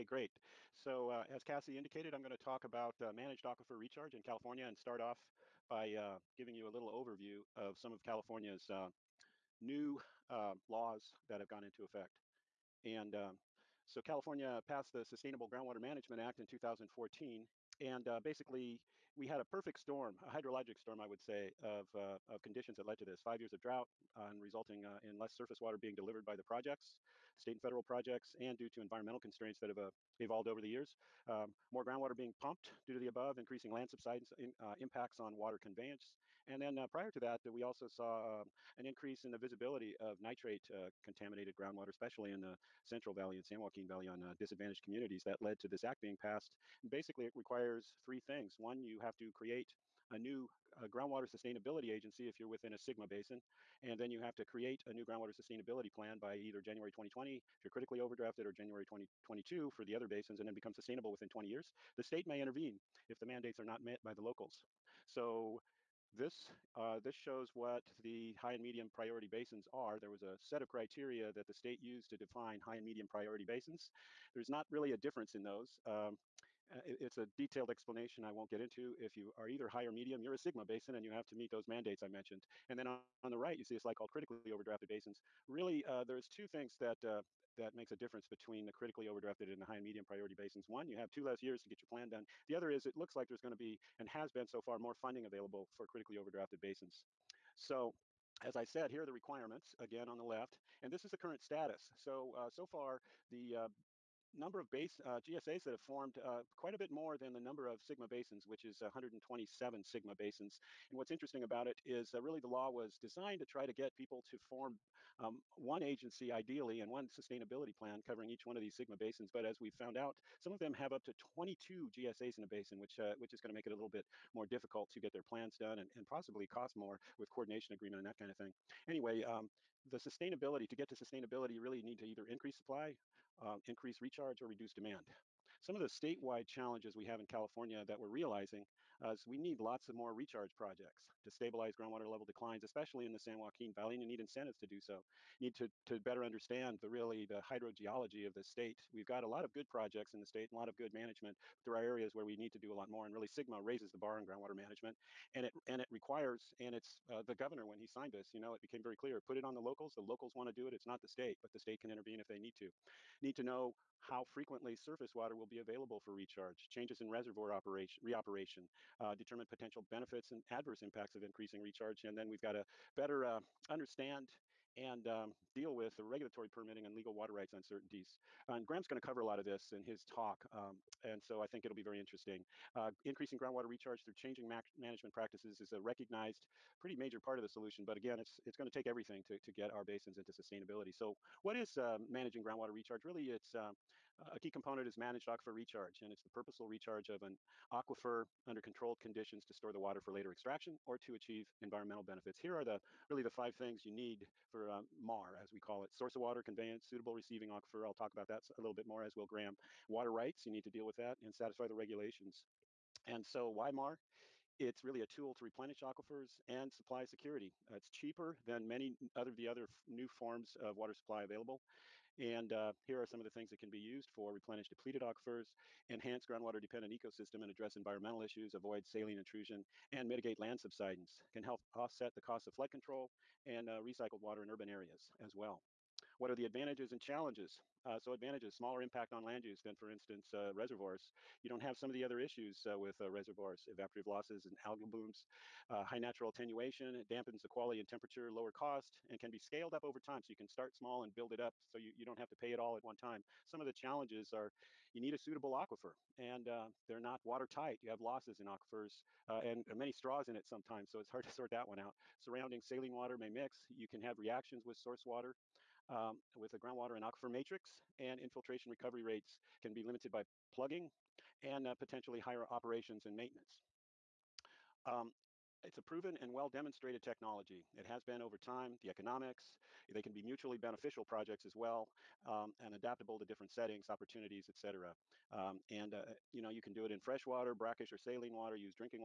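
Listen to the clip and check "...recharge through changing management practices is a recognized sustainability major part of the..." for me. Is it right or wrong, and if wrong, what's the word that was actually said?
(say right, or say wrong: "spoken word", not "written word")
wrong: "pretty", not "sustainability".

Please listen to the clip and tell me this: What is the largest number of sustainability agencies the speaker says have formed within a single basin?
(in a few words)
22.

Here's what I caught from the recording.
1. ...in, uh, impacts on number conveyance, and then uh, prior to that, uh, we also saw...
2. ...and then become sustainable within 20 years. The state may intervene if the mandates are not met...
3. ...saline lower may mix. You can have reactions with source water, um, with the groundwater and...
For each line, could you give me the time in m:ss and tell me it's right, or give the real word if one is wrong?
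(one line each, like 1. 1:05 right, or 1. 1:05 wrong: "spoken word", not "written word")
1. 0:34 wrong: "water", not "number"
2. 1:00 right
3. 4:22 wrong: "water", not "lower".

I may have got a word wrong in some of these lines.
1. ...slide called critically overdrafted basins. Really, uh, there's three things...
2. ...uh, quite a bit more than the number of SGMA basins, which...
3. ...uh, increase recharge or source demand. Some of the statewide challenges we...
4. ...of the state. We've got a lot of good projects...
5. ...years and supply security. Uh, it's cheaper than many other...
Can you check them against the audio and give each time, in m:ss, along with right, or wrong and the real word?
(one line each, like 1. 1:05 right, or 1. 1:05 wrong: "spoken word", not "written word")
1. 1:23 wrong: "two", not "three"
2. 1:46 right
3. 2:13 wrong: "reduce", not "source"
4. 2:28 right
5. 3:35 wrong: "aquifers", not "years".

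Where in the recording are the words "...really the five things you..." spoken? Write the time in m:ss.
3:23.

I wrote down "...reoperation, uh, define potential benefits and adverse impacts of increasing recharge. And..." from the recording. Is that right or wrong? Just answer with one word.
wrong.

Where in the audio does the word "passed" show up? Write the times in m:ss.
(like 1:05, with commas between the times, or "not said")
0:14, 0:46.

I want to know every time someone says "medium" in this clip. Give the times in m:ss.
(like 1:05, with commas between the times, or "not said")
1:08, 1:12, 1:19, 1:29.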